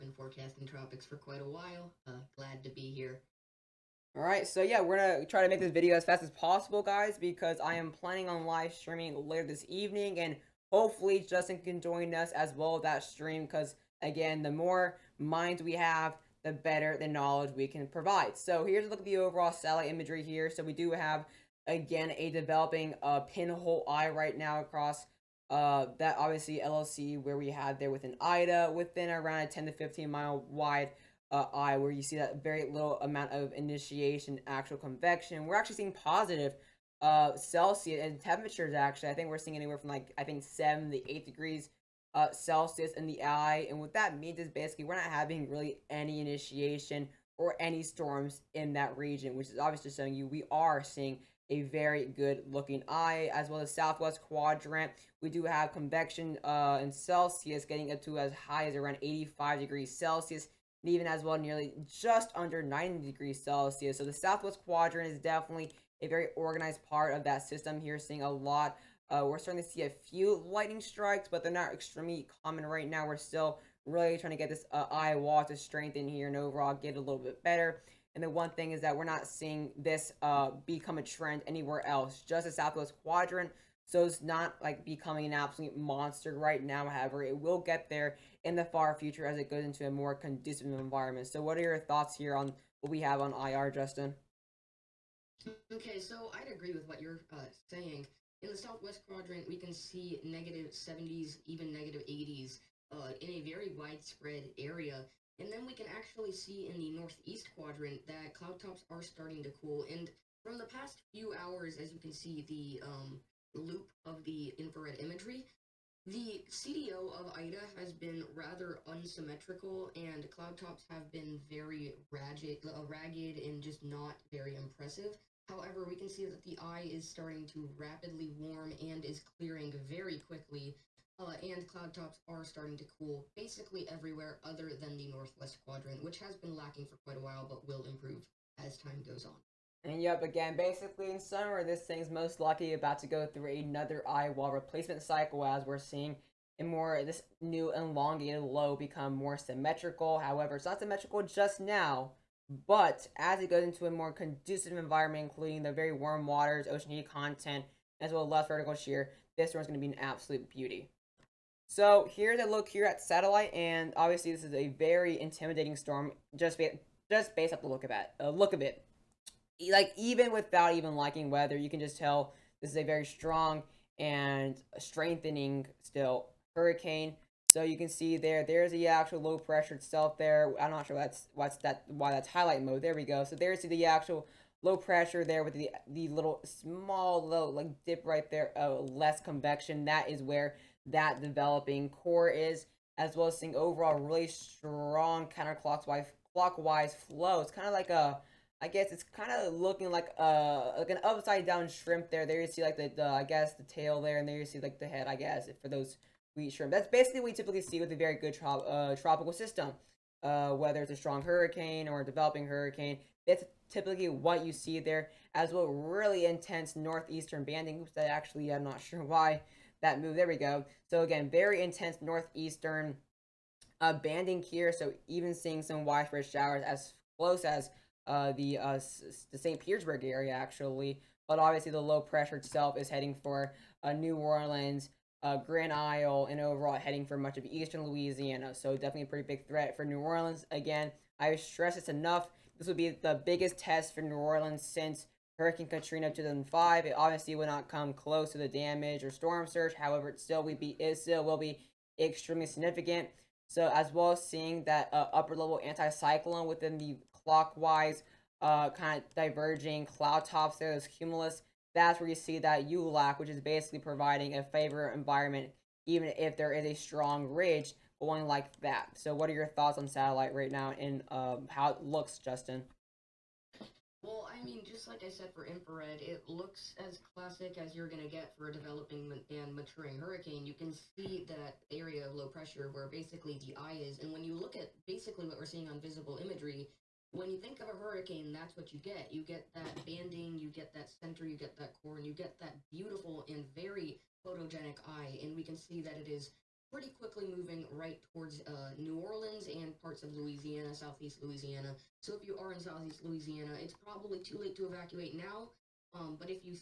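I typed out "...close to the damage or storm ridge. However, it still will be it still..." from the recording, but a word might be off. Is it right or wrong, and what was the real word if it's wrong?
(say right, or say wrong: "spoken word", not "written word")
wrong: "surge", not "ridge".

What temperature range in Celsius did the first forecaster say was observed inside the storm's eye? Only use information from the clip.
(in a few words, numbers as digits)
7 to 8 degrees.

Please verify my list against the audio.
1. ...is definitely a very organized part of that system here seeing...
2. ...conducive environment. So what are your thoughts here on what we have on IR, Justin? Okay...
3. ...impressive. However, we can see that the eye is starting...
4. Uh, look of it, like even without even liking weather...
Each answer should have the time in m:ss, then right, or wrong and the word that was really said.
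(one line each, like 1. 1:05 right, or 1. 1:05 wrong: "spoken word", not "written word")
1. 1:05 right
2. 1:30 right
3. 2:04 right
4. 2:48 right.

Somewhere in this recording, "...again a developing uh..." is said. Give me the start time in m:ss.
0:21.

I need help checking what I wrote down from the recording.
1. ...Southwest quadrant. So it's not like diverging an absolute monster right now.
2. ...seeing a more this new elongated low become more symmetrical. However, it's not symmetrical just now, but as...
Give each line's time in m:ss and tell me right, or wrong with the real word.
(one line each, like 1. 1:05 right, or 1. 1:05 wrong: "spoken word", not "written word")
1. 1:22 wrong: "becoming", not "diverging"
2. 2:25 right.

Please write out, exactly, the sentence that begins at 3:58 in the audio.
So definitely a pretty big threat for New Orleans.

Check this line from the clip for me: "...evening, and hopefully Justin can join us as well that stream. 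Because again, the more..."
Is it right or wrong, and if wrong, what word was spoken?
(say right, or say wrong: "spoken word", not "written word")
right.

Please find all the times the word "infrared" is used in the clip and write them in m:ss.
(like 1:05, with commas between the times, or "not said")
1:54, 4:35.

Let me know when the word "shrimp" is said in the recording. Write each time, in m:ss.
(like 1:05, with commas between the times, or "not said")
3:21, 3:26.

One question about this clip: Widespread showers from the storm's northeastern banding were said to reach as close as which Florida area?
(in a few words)
St. Petersburg.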